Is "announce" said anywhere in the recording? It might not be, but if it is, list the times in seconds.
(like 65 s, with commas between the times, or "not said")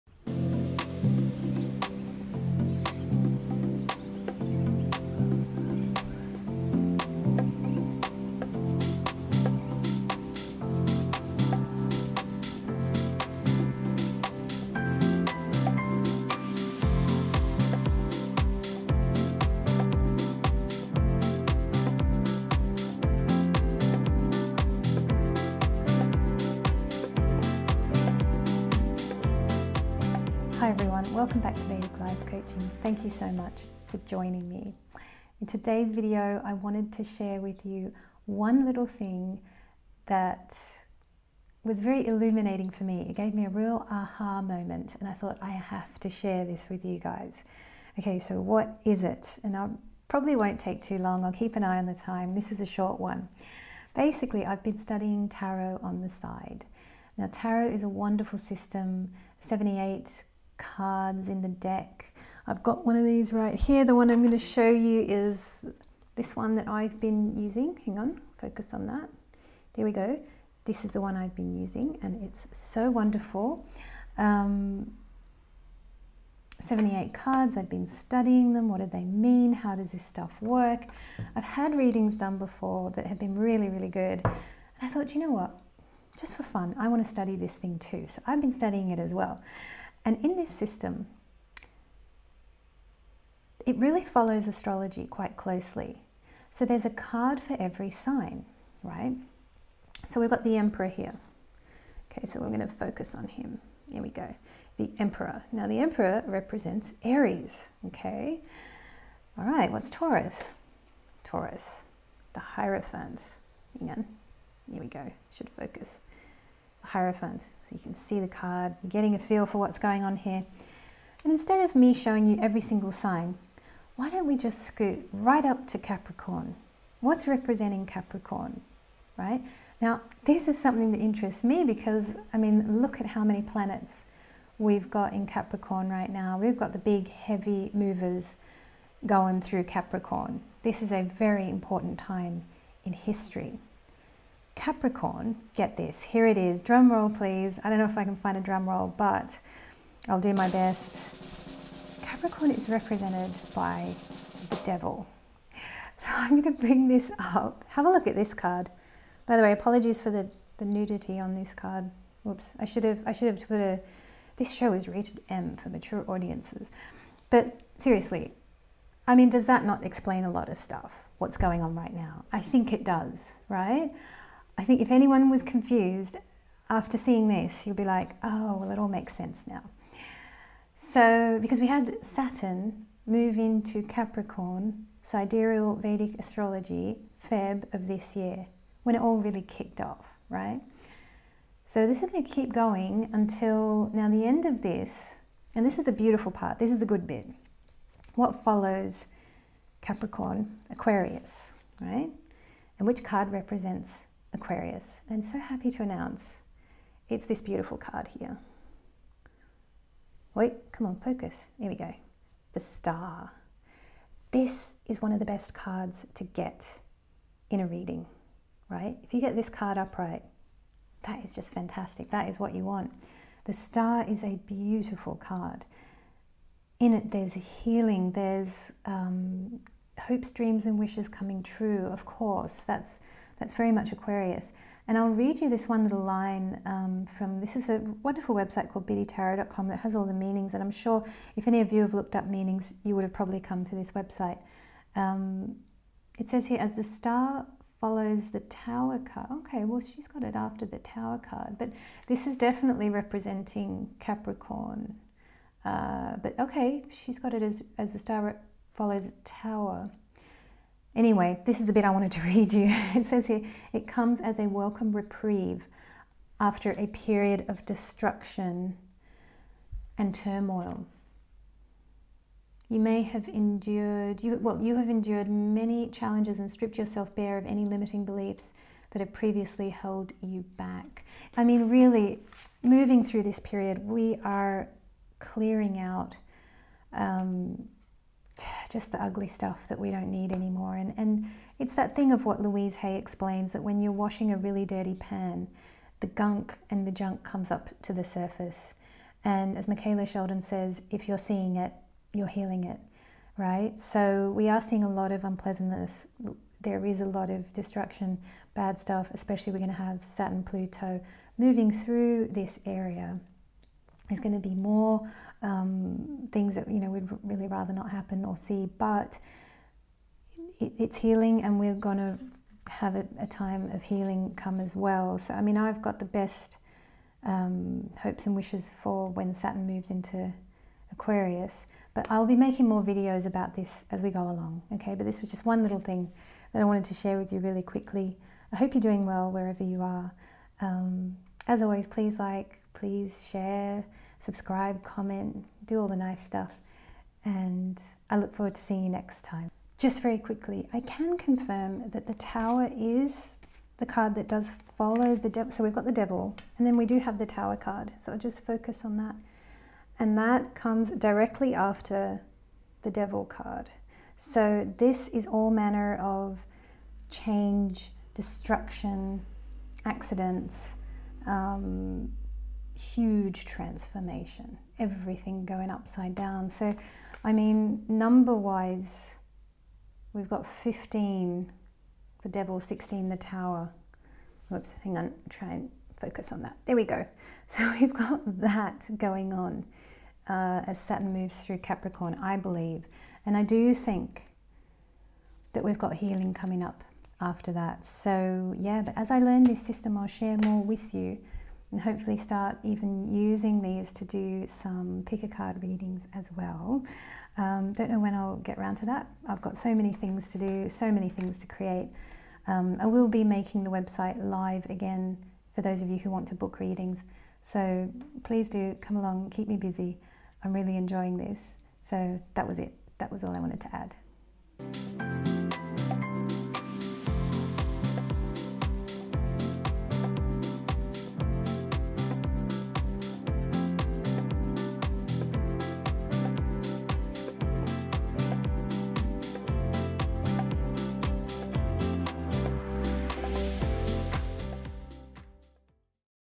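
205 s.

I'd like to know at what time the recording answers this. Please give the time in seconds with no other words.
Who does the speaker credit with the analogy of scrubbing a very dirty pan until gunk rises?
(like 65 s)
292 s.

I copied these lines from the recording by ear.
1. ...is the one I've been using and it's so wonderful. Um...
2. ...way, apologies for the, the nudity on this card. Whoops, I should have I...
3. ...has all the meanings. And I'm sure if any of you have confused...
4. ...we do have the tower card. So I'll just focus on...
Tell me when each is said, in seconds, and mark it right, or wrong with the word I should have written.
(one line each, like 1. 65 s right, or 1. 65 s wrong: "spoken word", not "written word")
1. 70 s right
2. 159 s right
3. 239 s wrong: "looked", not "confused"
4. 356 s right.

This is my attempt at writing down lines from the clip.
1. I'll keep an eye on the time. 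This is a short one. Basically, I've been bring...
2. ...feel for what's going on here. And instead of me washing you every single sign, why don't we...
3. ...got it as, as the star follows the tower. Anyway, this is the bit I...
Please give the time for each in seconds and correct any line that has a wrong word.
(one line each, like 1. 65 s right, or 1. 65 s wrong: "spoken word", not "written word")
1. 51 s wrong: "studying", not "bring"
2. 119 s wrong: "showing", not "washing"
3. 257 s right.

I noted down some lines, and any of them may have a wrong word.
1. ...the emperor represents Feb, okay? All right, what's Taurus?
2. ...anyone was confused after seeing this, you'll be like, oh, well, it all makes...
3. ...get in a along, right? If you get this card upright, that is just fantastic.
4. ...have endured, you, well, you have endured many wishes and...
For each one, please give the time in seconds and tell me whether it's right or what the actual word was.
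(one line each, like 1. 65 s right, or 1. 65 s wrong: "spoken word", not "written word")
1. 105 s wrong: "Aries", not "Feb"
2. 174 s right
3. 216 s wrong: "reading", not "along"
4. 273 s wrong: "challenges", not "wishes".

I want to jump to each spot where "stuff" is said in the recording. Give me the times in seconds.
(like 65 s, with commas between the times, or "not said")
80 s, 170 s, 289 s, 308 s, 346 s.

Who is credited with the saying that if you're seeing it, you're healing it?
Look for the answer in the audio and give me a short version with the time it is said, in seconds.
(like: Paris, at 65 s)
Michaela Sheldon, at 299 s.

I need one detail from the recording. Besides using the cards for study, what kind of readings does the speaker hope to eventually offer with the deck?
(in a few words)
Pick a card readings.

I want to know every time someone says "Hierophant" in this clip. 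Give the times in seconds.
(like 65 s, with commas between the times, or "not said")
112 s, 116 s.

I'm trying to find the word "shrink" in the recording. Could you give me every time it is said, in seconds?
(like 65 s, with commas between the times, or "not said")
not said.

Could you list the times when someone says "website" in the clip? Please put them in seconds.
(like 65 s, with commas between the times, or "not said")
238 s, 243 s, 413 s.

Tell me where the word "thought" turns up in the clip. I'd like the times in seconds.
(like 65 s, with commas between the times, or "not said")
45 s, 84 s.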